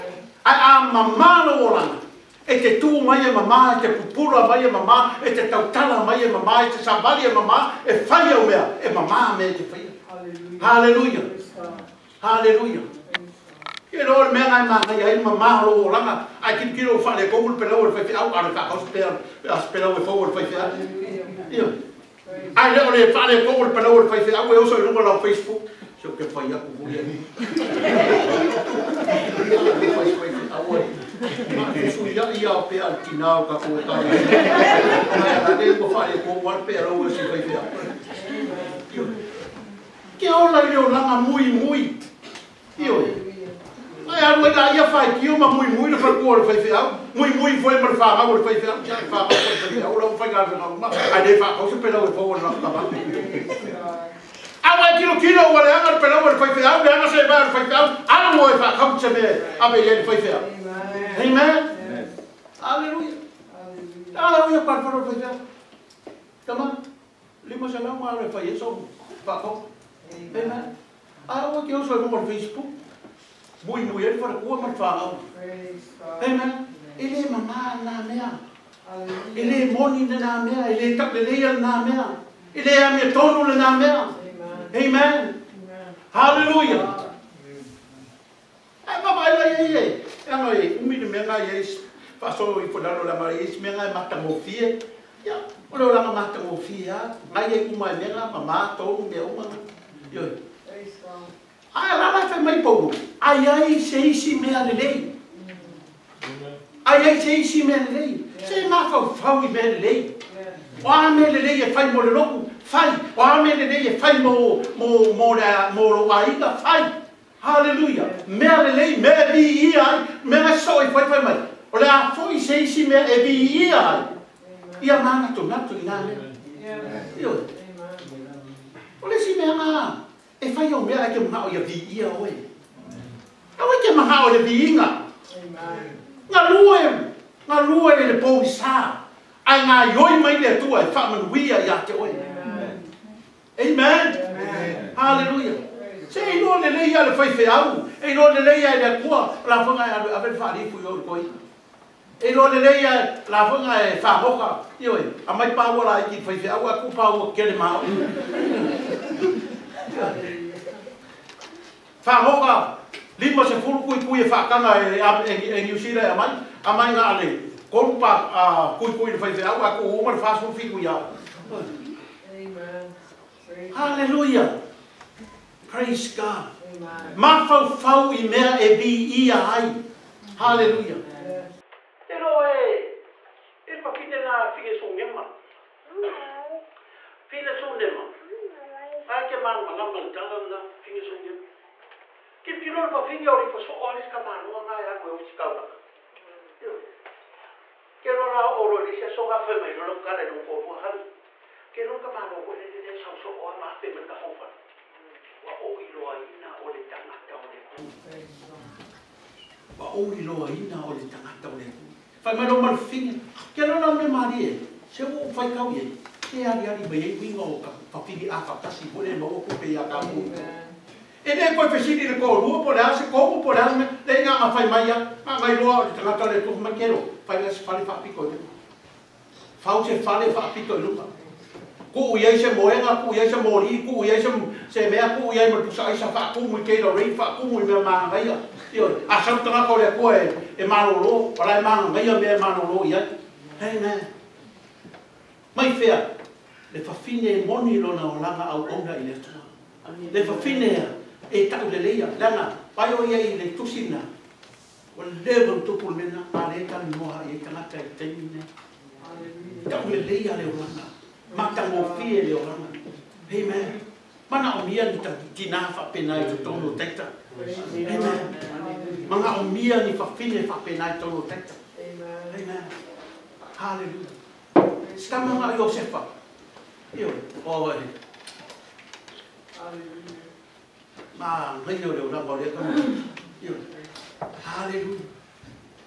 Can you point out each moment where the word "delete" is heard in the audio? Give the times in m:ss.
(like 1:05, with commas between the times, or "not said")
not said.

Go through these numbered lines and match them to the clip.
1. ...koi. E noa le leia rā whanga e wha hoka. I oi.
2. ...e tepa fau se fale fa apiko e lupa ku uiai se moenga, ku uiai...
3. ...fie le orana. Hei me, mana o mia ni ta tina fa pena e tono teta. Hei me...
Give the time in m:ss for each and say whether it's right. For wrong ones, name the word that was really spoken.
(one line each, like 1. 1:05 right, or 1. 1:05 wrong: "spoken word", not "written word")
1. 2:31 right
2. 3:48 right
3. 4:21 right.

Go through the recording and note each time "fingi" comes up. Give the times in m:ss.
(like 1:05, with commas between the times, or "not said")
3:10.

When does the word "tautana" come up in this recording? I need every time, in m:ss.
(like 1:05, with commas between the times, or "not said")
0:05.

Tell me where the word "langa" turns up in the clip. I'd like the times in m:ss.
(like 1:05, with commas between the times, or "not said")
0:01, 4:08.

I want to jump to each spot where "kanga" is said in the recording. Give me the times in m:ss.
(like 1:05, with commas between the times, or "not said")
2:44.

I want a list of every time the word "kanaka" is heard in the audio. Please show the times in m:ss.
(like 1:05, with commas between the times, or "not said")
4:17.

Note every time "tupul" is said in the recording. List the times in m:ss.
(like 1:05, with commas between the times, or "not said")
4:15.